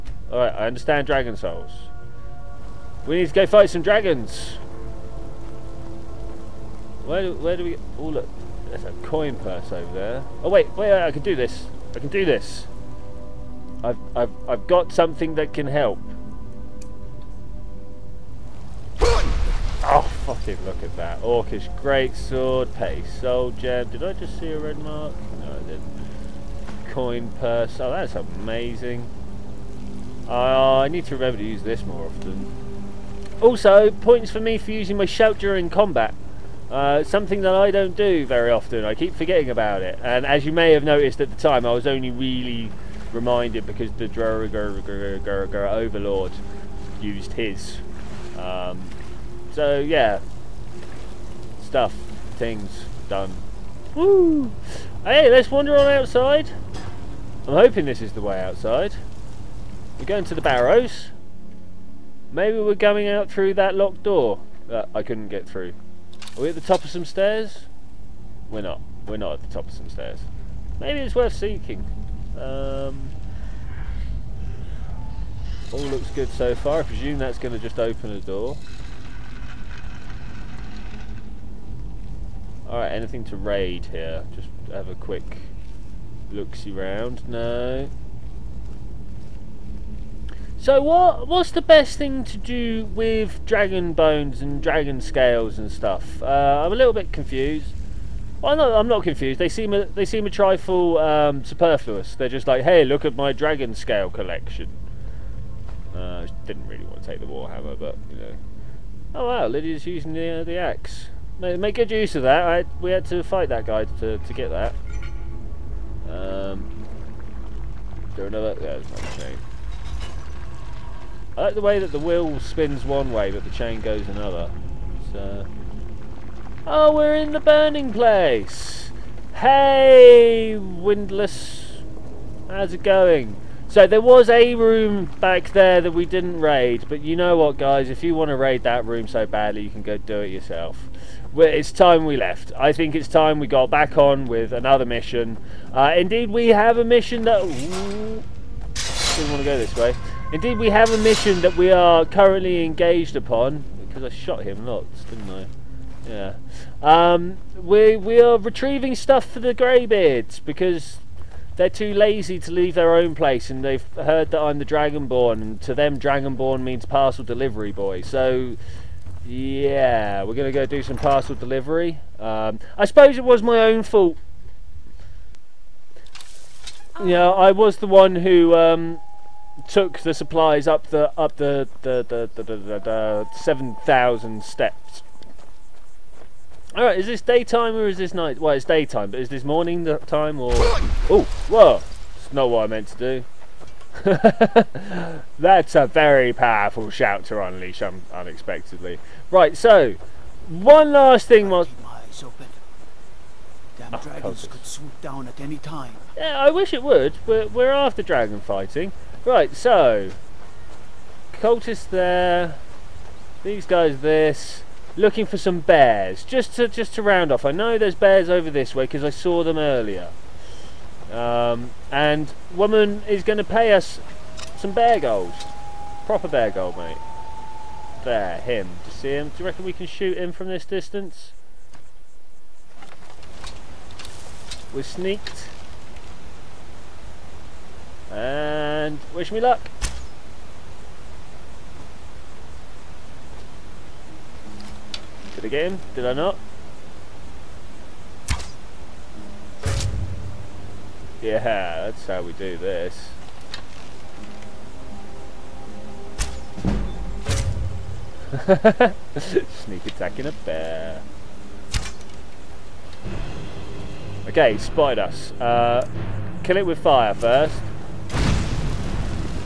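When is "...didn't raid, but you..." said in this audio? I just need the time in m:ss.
2:16.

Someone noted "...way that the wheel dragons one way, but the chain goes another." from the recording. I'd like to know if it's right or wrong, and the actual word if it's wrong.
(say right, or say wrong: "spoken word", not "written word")
wrong: "spins", not "dragons".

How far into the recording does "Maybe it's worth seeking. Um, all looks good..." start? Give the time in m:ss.
1:10.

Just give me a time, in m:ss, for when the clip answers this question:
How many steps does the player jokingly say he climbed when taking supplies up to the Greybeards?
3:03.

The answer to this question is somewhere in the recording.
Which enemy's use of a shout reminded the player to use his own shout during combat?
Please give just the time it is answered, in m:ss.
0:44.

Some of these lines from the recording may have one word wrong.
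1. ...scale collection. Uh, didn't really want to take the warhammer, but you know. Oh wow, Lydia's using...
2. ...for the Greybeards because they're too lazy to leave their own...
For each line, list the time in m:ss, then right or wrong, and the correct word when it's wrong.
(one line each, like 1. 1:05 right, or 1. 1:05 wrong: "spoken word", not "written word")
1. 1:43 right
2. 2:39 right.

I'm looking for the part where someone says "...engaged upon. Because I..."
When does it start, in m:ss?
2:32.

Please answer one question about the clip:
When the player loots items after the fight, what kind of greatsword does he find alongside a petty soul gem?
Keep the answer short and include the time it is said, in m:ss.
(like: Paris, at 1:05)
Orcish, at 0:21.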